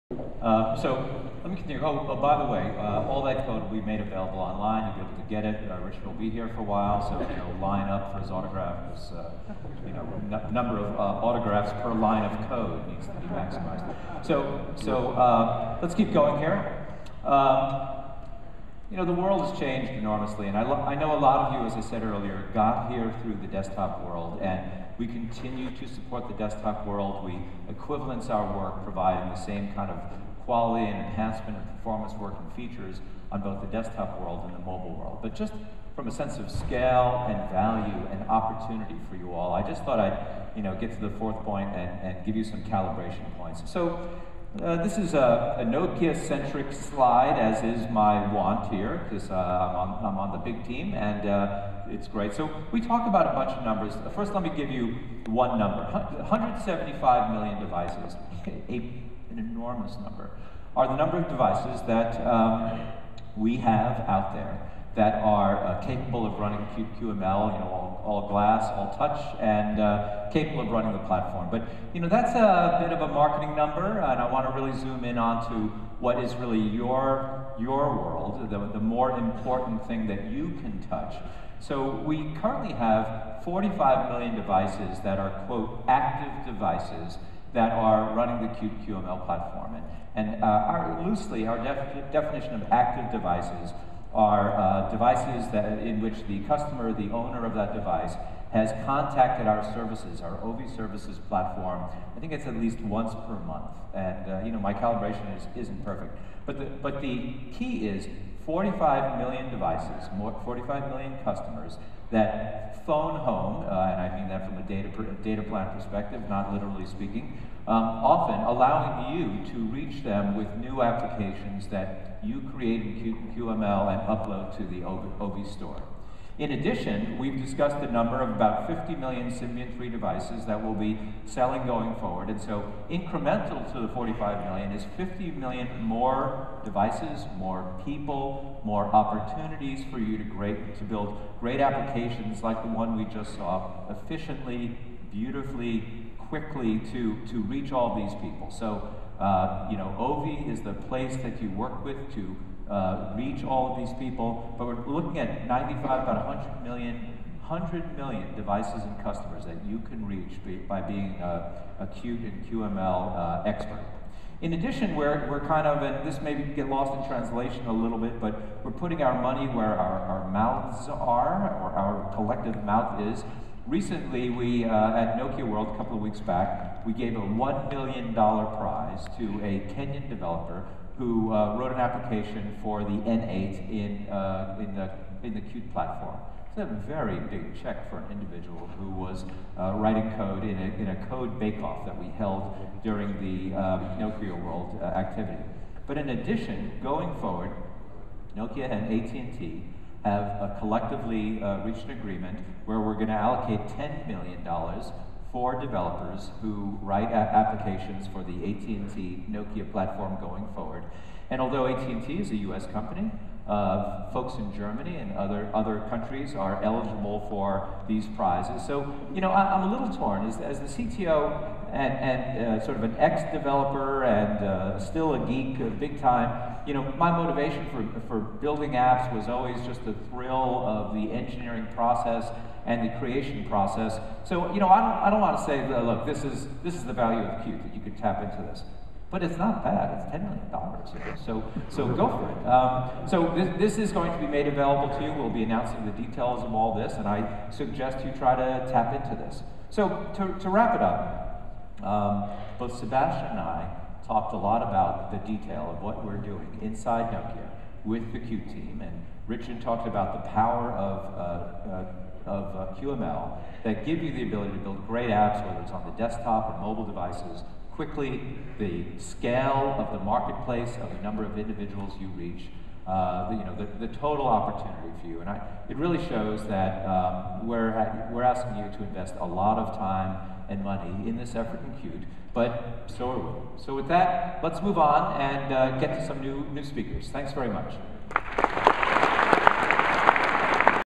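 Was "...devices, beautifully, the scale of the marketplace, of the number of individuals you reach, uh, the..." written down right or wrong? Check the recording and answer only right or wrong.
wrong.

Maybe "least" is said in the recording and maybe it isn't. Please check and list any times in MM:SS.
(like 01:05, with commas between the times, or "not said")
01:42.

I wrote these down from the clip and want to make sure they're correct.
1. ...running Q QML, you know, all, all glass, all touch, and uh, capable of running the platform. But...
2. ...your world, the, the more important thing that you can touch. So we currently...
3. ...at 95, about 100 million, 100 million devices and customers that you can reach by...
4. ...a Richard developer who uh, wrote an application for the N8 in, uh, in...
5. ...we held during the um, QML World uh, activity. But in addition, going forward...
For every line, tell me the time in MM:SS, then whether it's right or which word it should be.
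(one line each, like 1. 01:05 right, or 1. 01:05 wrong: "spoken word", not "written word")
1. 01:06 right
2. 01:17 right
3. 02:35 right
4. 02:59 wrong: "Kenyan", not "Richard"
5. 03:11 wrong: "Nokia", not "QML".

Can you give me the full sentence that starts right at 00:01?
Oh, oh by the way, uh, all that code will be made available online.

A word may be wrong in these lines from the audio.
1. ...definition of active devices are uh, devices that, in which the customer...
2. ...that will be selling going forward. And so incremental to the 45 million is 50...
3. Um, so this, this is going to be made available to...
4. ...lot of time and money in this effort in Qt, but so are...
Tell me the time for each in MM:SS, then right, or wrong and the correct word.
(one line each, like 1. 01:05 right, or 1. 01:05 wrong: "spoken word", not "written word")
1. 01:32 right
2. 02:10 right
3. 04:02 right
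4. 04:39 right.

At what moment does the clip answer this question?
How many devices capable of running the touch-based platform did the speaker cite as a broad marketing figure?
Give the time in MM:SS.
00:55.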